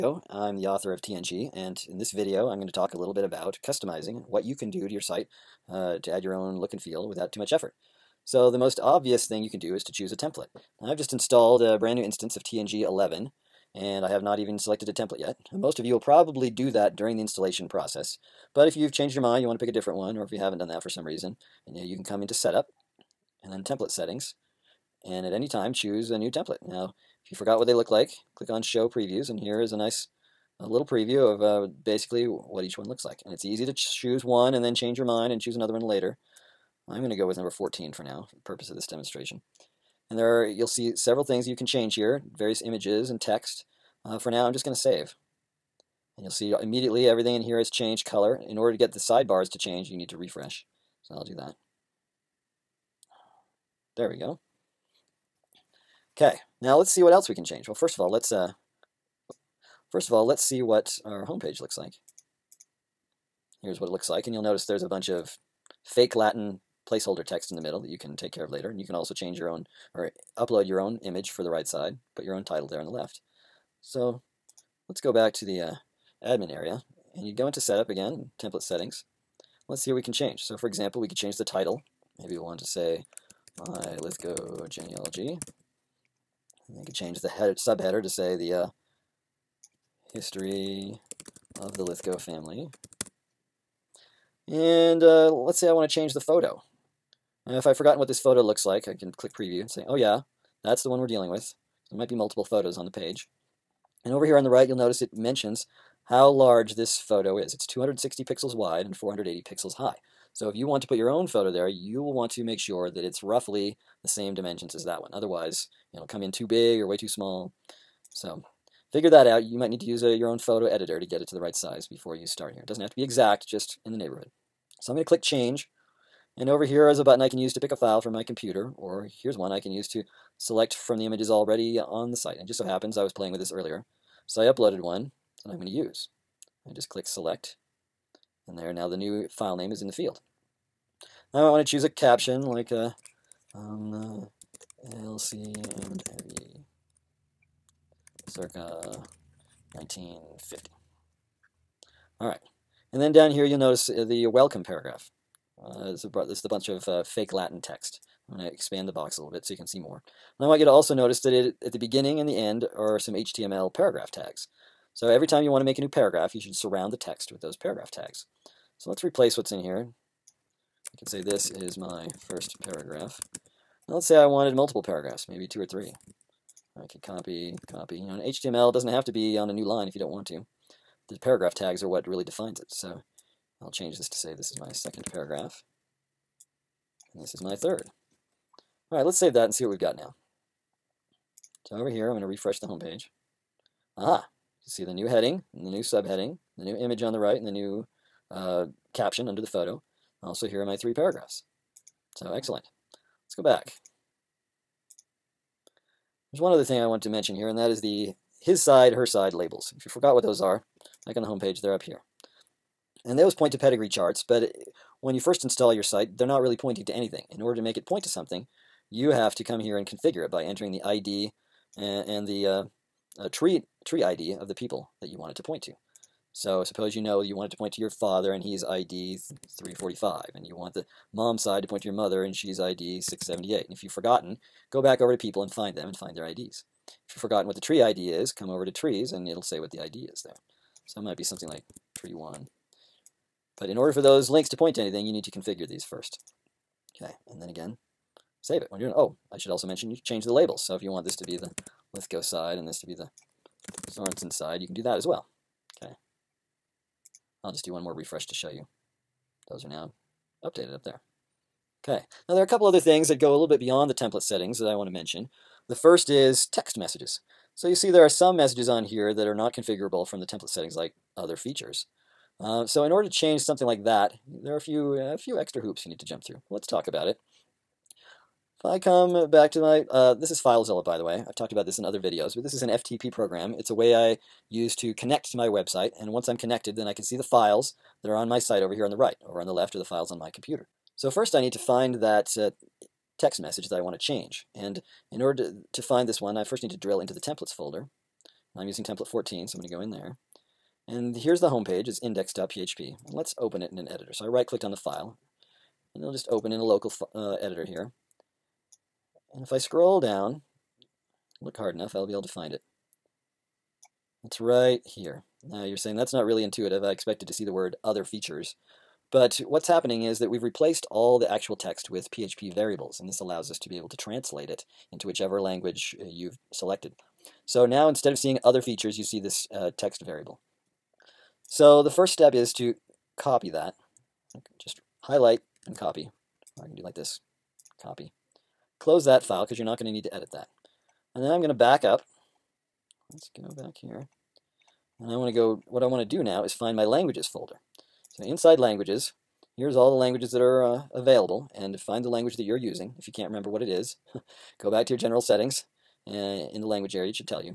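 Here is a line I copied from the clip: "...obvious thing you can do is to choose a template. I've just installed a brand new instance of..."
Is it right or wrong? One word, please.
right.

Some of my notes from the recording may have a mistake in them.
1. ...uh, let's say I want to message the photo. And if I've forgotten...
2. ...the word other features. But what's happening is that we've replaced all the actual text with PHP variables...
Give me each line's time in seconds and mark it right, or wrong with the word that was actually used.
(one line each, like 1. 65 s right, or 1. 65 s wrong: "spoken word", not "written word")
1. 95 s wrong: "change", not "message"
2. 317 s right.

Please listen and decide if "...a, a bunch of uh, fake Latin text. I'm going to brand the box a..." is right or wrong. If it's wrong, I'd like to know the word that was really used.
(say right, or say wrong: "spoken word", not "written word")
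wrong: "expand", not "brand".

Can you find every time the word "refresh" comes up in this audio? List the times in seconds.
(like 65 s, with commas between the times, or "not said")
50 s, 192 s, 257 s.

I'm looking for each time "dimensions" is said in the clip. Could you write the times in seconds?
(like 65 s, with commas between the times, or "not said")
114 s.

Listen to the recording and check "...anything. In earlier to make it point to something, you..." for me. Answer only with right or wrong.
wrong.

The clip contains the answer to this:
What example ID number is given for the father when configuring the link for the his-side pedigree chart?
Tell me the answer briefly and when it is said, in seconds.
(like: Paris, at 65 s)
345, at 228 s.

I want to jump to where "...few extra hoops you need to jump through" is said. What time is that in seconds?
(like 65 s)
275 s.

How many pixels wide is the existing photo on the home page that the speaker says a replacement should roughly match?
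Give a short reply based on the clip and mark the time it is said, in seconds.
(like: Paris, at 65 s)
260, at 107 s.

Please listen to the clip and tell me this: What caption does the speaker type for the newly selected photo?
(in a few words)
LC and heavy circa 1950.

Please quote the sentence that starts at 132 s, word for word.
And just so happens I was playing with this earlier.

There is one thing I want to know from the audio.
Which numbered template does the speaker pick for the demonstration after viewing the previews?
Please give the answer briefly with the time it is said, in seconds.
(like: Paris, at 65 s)
14, at 37 s.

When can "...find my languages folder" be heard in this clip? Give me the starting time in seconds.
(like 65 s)
346 s.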